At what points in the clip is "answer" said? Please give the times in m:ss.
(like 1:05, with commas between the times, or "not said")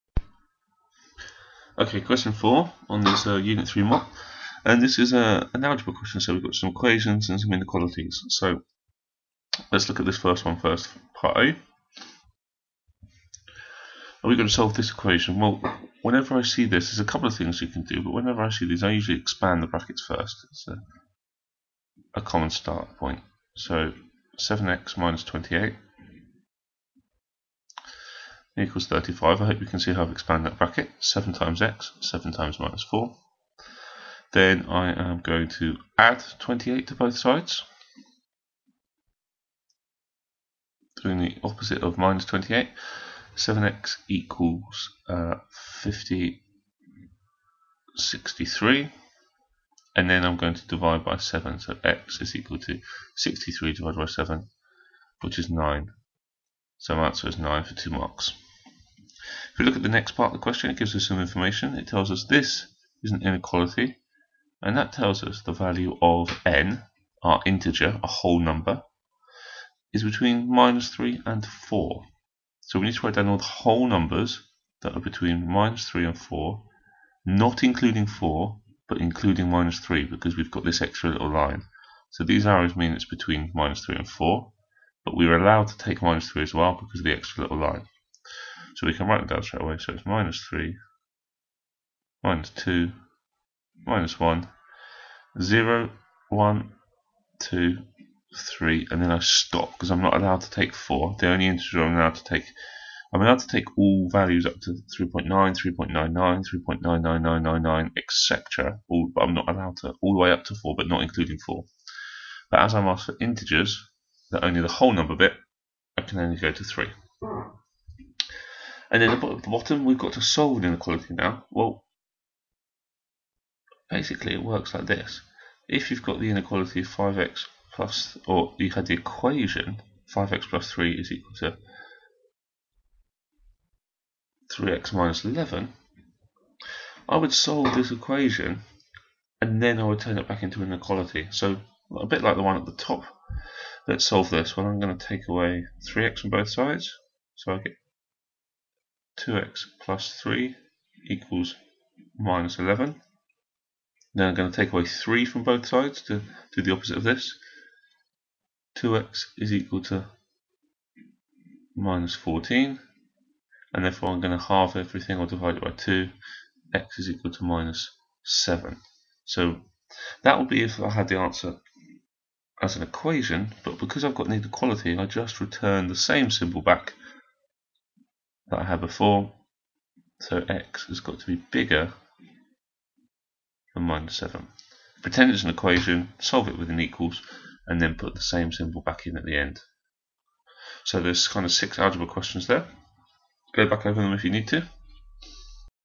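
0:57, 2:51.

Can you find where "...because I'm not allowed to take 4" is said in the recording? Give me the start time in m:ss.
1:39.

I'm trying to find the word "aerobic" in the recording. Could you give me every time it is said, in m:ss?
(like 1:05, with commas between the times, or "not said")
not said.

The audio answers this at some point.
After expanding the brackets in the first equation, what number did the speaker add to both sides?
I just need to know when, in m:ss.
0:35.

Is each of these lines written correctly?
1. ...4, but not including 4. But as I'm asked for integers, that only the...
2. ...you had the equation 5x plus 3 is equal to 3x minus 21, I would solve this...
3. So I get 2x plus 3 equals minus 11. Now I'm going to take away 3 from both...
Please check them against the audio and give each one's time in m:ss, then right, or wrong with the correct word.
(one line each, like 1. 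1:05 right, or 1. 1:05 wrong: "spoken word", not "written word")
1. 1:50 right
2. 2:08 wrong: "11", not "21"
3. 2:27 right.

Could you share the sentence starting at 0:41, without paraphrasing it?
Doing the opposite of minus 28.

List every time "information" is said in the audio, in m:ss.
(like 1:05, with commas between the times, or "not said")
1:01.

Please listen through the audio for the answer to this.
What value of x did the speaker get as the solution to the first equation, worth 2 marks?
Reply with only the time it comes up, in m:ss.
0:55.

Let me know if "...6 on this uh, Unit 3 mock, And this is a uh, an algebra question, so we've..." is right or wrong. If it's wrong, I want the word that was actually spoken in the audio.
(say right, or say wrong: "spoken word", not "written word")
wrong: "4", not "6".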